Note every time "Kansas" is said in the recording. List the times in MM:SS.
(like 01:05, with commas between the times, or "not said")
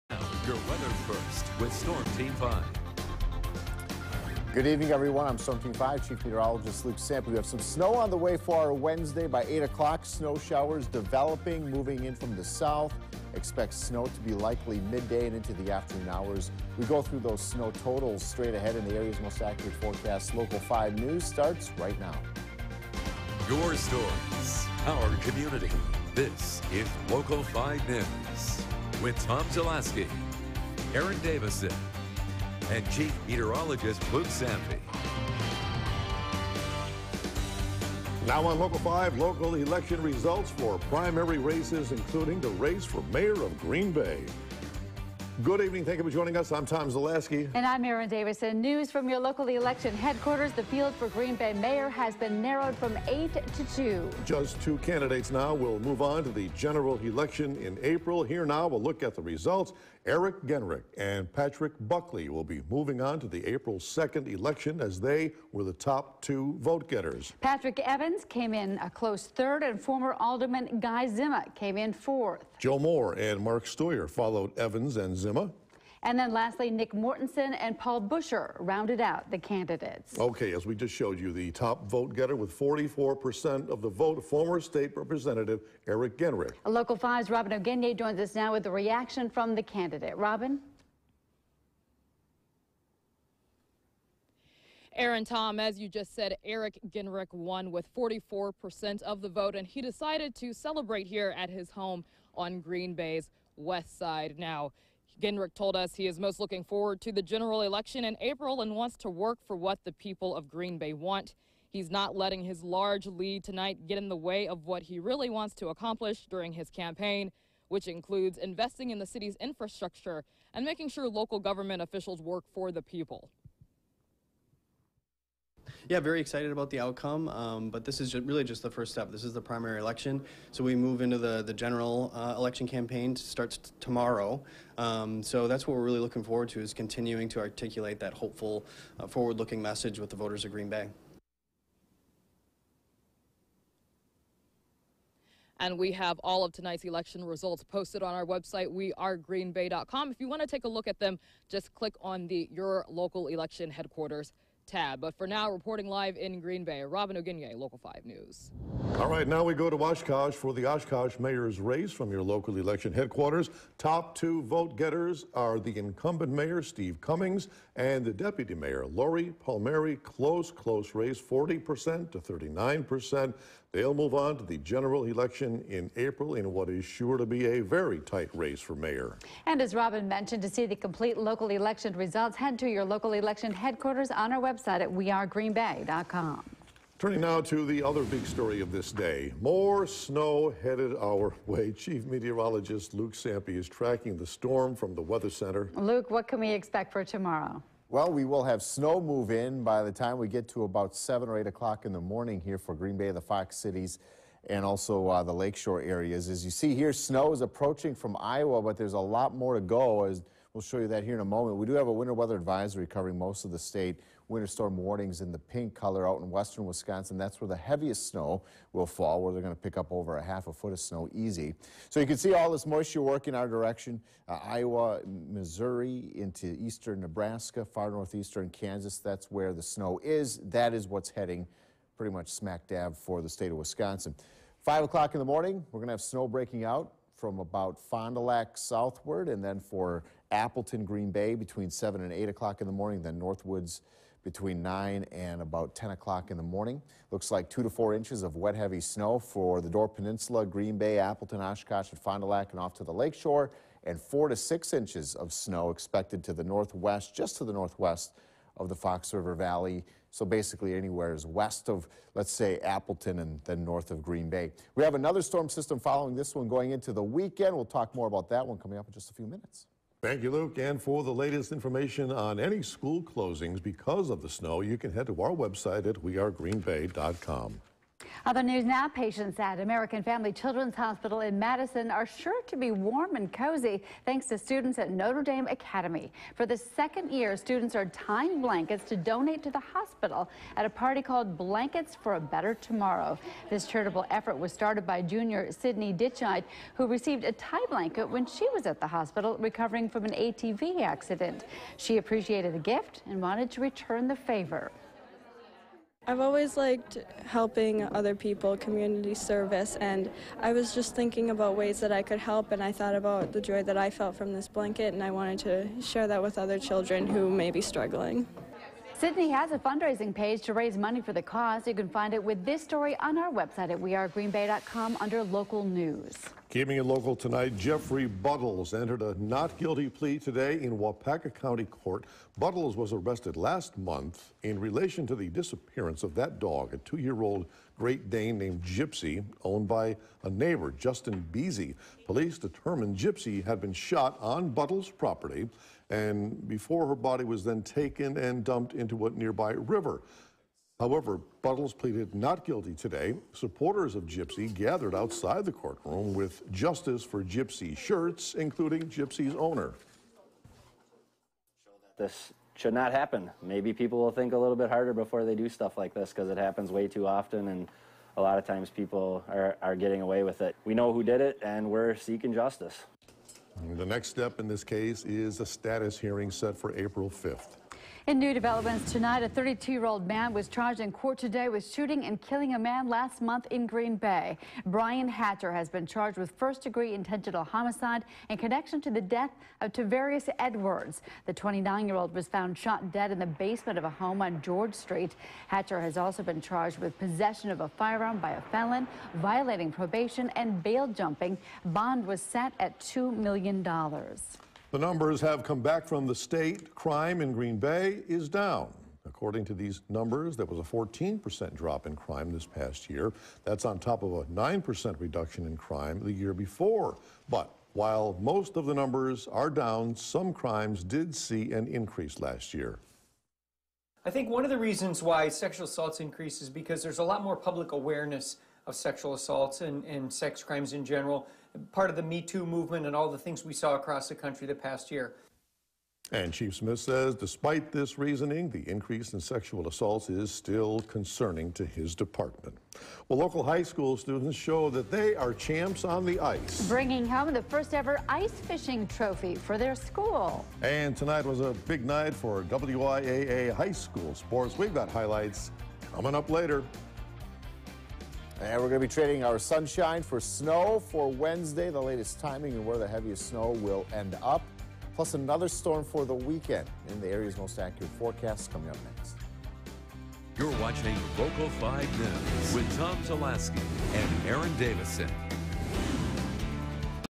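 03:48.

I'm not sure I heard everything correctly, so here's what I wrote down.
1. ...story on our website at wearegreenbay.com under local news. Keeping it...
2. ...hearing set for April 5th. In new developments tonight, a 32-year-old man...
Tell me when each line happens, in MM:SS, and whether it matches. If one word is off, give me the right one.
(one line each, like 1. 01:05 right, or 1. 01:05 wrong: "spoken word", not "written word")
1. 05:22 right
2. 06:15 right.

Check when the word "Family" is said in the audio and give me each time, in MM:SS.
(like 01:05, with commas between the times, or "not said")
04:40.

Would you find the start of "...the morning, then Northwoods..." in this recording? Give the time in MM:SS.
04:02.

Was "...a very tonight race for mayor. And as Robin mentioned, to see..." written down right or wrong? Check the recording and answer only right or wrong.
wrong.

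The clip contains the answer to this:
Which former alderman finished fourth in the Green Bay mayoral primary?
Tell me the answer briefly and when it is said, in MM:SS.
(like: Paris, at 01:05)
Guy Zima, at 01:10.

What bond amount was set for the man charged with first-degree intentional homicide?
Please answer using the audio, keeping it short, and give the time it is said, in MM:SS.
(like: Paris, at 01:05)
$2 million, at 06:42.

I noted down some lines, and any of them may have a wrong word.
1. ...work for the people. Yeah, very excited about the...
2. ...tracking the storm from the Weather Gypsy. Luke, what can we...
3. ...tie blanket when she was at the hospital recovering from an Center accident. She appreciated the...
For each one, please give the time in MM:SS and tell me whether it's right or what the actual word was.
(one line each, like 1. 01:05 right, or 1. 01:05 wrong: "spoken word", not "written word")
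1. 02:02 right
2. 03:13 wrong: "Center", not "Gypsy"
3. 04:57 wrong: "ATV", not "Center".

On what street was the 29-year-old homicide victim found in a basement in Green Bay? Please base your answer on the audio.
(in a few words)
George Street.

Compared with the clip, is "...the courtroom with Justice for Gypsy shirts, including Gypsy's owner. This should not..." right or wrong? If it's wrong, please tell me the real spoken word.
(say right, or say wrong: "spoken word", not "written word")
right.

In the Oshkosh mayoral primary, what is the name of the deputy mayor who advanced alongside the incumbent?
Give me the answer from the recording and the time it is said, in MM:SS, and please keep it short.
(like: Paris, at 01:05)
Lori Palmeri, at 02:48.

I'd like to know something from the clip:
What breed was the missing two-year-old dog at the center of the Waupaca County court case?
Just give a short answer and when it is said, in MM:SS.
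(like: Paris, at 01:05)
Great Dane, at 05:37.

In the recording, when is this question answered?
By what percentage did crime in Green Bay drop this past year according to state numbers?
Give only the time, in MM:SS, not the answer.
06:50.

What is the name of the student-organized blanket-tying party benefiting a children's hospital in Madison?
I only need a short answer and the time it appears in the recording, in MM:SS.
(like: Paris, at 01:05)
Blankets for a Better Tomorrow, at 04:51.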